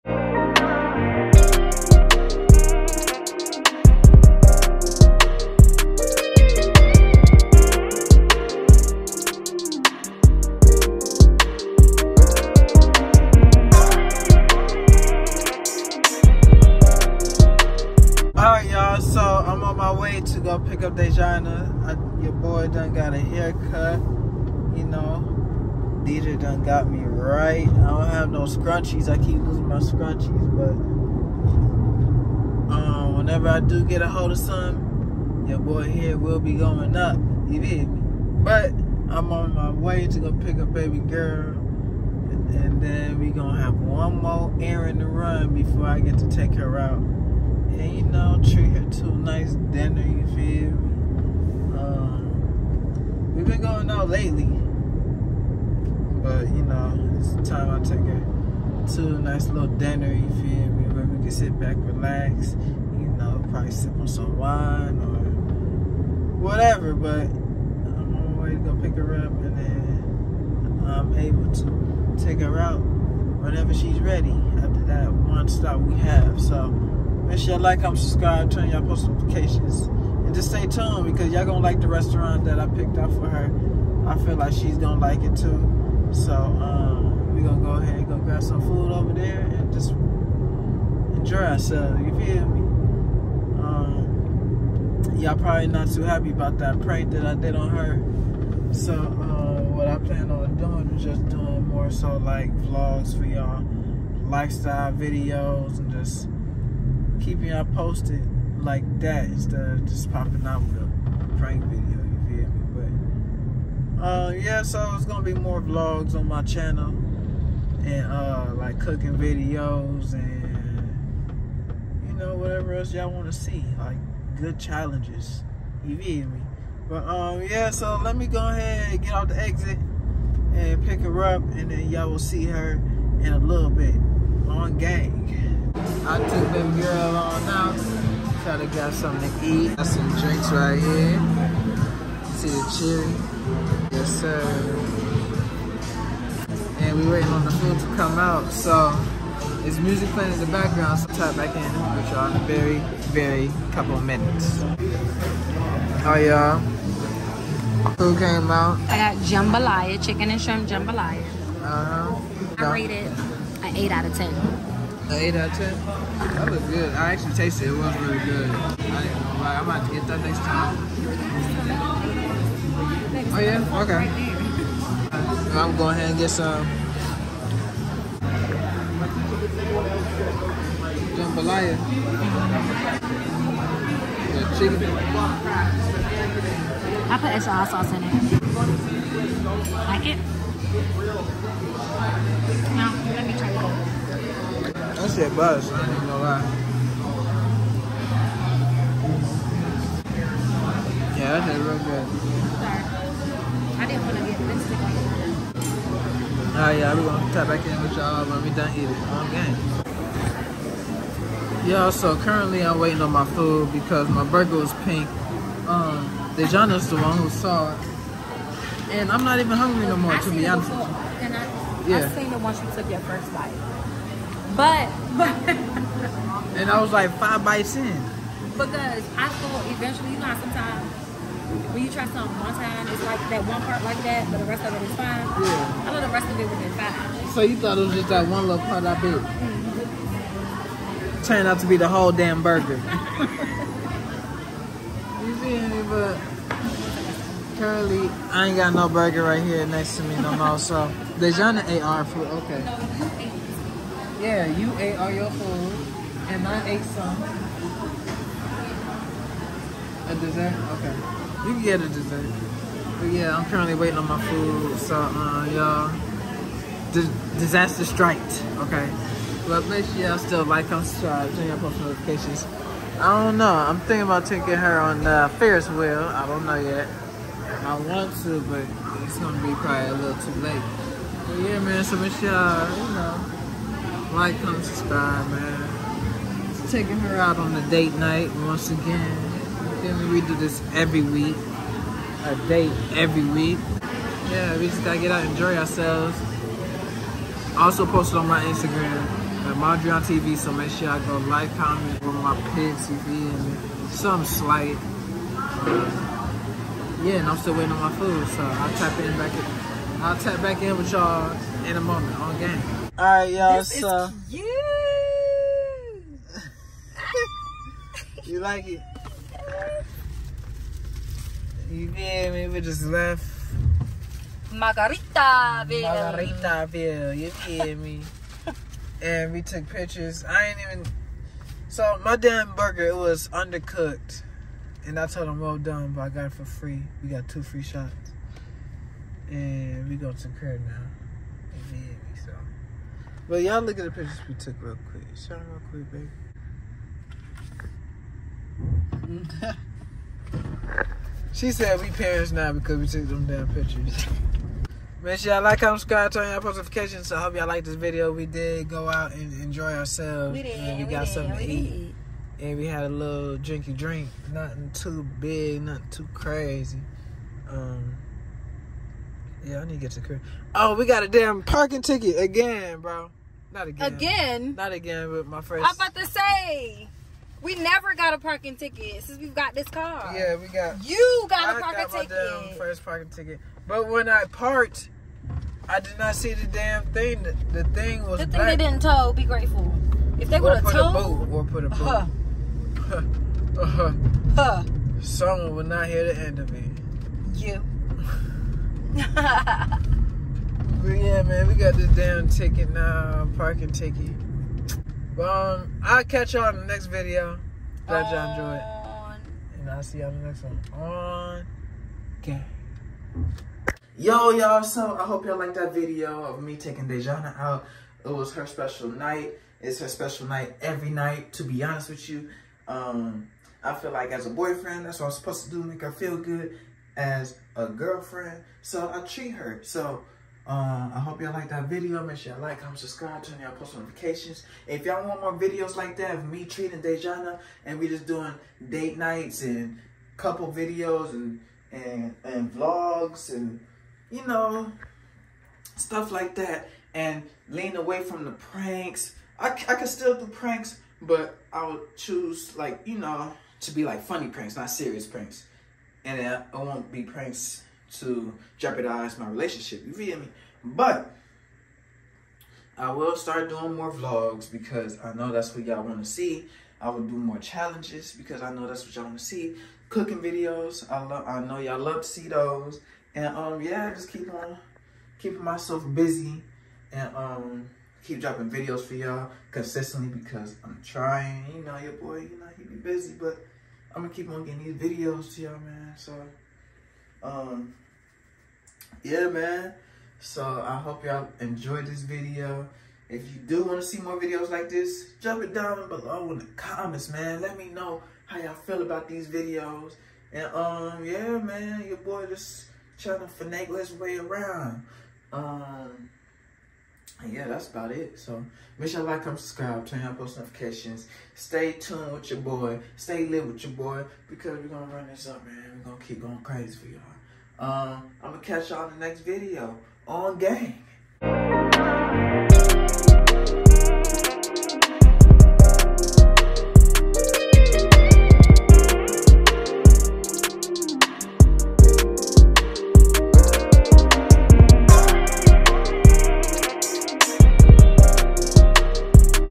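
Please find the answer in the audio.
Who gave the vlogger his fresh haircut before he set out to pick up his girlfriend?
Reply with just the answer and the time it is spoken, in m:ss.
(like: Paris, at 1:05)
DJ, at 0:26.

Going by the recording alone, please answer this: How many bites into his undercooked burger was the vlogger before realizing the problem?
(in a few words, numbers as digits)
5.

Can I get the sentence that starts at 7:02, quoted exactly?
Um, I feel like as a boyfriend, that's what I'm supposed to do, make her feel good.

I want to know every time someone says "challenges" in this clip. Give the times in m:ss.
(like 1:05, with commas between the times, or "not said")
2:04, 7:47.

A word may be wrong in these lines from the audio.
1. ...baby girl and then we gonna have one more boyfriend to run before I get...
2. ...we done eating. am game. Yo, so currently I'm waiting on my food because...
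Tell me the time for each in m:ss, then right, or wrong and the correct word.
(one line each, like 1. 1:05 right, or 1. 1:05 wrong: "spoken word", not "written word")
1. 0:40 wrong: "errand", not "boyfriend"
2. 3:28 right.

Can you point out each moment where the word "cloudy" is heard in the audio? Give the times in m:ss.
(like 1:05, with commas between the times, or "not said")
not said.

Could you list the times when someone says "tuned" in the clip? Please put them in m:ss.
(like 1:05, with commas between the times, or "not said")
1:20, 8:31.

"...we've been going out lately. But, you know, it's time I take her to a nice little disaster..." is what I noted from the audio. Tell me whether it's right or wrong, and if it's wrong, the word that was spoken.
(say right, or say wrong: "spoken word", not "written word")
wrong: "dinner", not "disaster".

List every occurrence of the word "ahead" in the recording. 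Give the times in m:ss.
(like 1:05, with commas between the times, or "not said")
1:27, 2:08, 2:55.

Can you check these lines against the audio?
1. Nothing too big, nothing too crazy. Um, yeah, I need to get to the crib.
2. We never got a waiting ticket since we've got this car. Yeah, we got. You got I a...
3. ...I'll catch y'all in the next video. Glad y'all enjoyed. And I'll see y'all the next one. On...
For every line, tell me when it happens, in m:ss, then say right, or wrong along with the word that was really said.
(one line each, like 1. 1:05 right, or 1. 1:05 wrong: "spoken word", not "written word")
1. 6:04 right
2. 6:17 wrong: "parking", not "waiting"
3. 6:45 right.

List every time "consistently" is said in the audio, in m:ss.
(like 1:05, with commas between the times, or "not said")
7:59.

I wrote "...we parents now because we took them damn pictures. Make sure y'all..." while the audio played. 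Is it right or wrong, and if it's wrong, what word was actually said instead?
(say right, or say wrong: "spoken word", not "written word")
right.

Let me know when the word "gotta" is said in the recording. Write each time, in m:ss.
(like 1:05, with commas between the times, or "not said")
4:54.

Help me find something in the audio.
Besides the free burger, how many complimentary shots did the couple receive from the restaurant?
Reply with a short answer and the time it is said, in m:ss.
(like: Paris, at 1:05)
2, at 5:37.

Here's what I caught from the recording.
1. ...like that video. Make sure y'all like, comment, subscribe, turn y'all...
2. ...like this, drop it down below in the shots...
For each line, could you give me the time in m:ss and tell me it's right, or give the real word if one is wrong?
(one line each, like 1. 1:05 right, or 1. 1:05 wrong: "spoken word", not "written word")
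1. 7:11 right
2. 8:14 wrong: "comments", not "shots".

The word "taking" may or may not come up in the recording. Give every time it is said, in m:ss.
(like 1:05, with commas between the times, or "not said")
4:34, 4:46, 6:56.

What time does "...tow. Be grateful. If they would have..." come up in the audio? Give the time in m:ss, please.
6:28.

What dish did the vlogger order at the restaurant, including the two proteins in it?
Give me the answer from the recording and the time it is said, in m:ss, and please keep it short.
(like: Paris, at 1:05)
Chicken and shrimp jambalaya, at 2:40.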